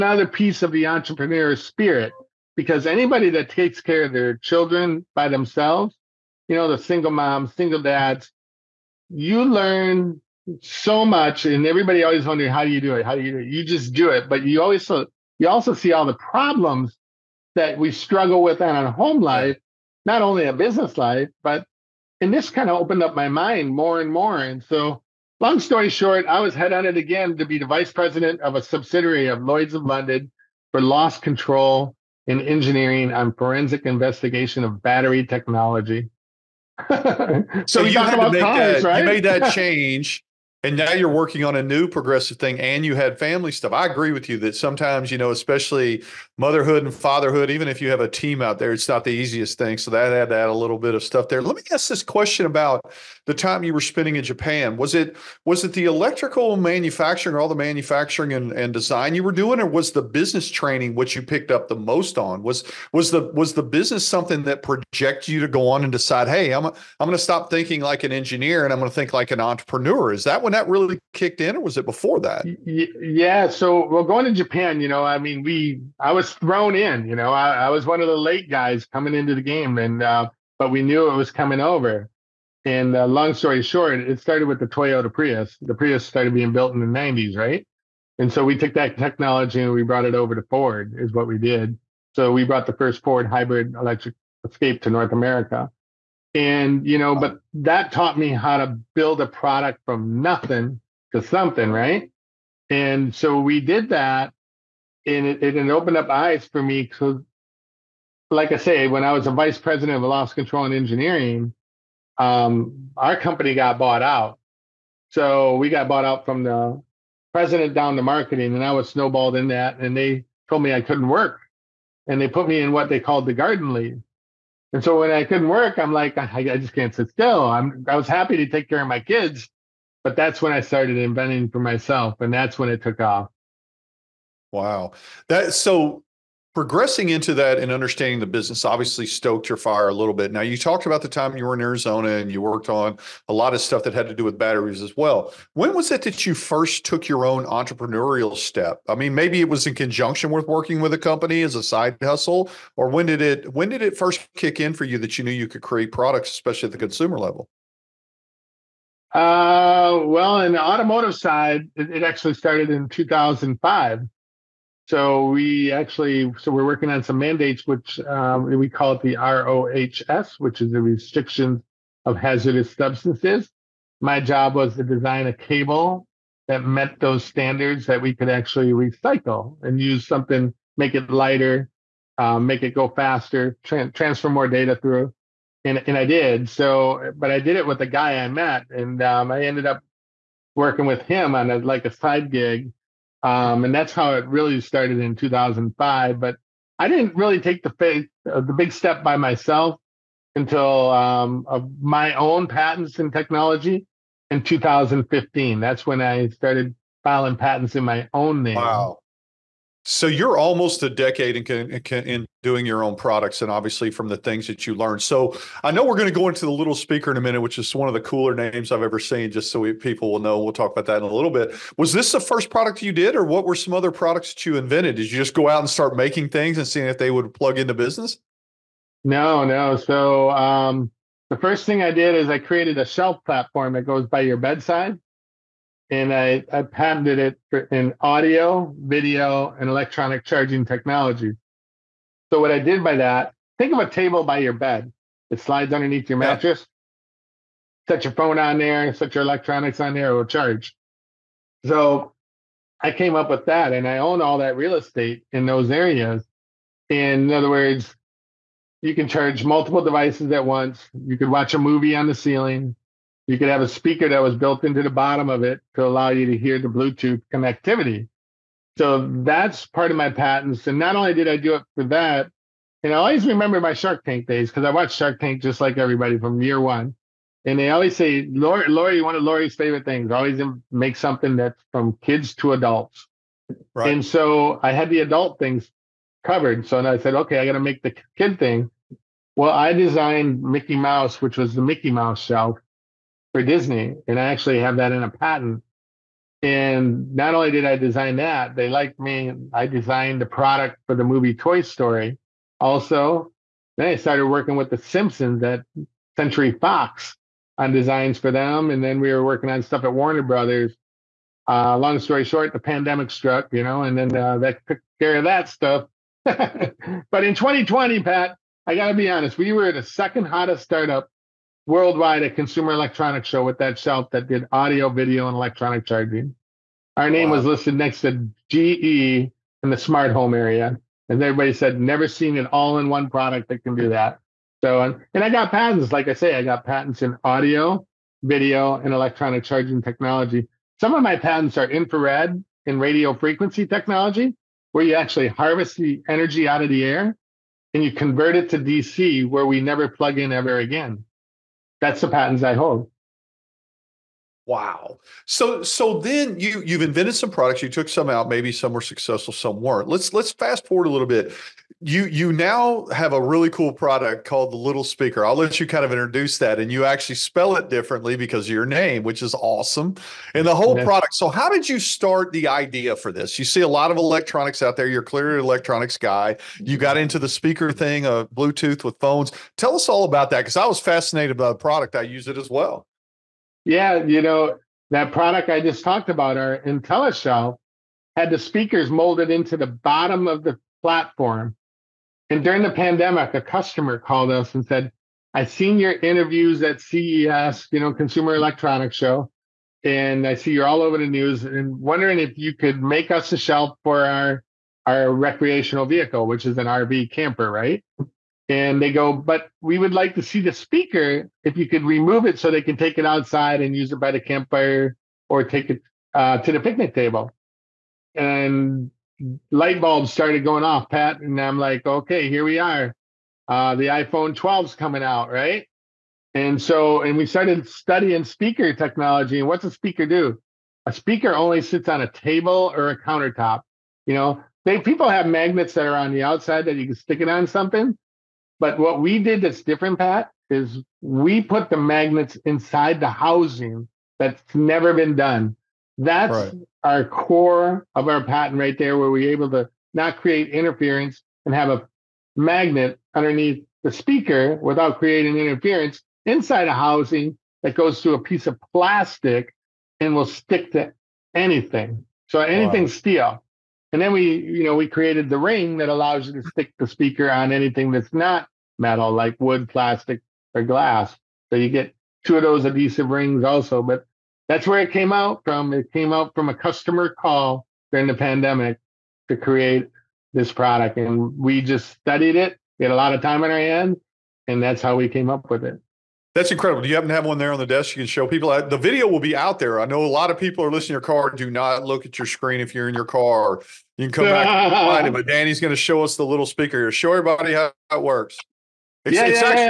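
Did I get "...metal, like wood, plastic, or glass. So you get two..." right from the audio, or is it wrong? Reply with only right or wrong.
right.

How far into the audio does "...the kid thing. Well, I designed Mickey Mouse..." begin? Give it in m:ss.
4:47.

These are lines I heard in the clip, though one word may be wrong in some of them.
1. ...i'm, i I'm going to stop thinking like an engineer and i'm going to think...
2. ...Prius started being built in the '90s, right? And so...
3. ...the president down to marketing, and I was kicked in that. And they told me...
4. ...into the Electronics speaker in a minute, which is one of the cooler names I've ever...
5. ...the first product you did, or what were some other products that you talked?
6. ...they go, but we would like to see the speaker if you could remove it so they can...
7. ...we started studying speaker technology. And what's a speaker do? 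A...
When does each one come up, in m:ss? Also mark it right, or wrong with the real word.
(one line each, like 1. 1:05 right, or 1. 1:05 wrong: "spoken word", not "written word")
1. 1:06 right
2. 1:25 right
3. 1:56 wrong: "snowballed", not "kicked"
4. 3:36 wrong: "Liddle", not "Electronics"
5. 3:42 wrong: "invented", not "talked"
6. 6:48 right
7. 7:07 right.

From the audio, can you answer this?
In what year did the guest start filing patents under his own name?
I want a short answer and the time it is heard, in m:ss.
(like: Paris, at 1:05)
2015, at 3:24.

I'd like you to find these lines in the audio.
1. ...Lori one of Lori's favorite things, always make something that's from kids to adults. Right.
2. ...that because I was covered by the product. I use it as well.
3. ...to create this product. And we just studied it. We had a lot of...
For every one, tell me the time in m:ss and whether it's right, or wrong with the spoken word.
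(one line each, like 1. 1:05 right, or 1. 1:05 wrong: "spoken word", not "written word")
1. 4:38 right
2. 6:20 wrong: "fascinated", not "covered"
3. 7:59 right.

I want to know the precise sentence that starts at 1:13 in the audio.
So, well, going to Japan, you know, I mean, we I was thrown in.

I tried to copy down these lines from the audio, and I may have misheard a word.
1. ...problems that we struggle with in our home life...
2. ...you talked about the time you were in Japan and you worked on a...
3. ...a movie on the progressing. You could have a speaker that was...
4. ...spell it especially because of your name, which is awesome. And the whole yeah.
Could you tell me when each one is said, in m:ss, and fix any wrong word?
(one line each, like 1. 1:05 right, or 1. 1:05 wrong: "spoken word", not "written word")
1. 0:16 right
2. 2:20 wrong: "Arizona", not "Japan"
3. 4:21 wrong: "ceiling", not "progressing"
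4. 6:07 wrong: "differently", not "especially".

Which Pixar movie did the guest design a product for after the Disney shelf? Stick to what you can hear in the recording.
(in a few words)
Toy Story.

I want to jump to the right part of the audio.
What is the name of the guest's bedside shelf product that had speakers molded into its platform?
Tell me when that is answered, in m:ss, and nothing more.
6:26.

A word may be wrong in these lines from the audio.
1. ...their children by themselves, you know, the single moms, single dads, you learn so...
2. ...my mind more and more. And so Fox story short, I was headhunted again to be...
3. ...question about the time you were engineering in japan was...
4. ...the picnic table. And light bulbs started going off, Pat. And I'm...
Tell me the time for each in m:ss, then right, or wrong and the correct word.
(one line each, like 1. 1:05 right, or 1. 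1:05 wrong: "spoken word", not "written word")
1. 0:04 right
2. 0:23 wrong: "Long", not "Fox"
3. 0:52 wrong: "spending", not "engineering"
4. 6:56 right.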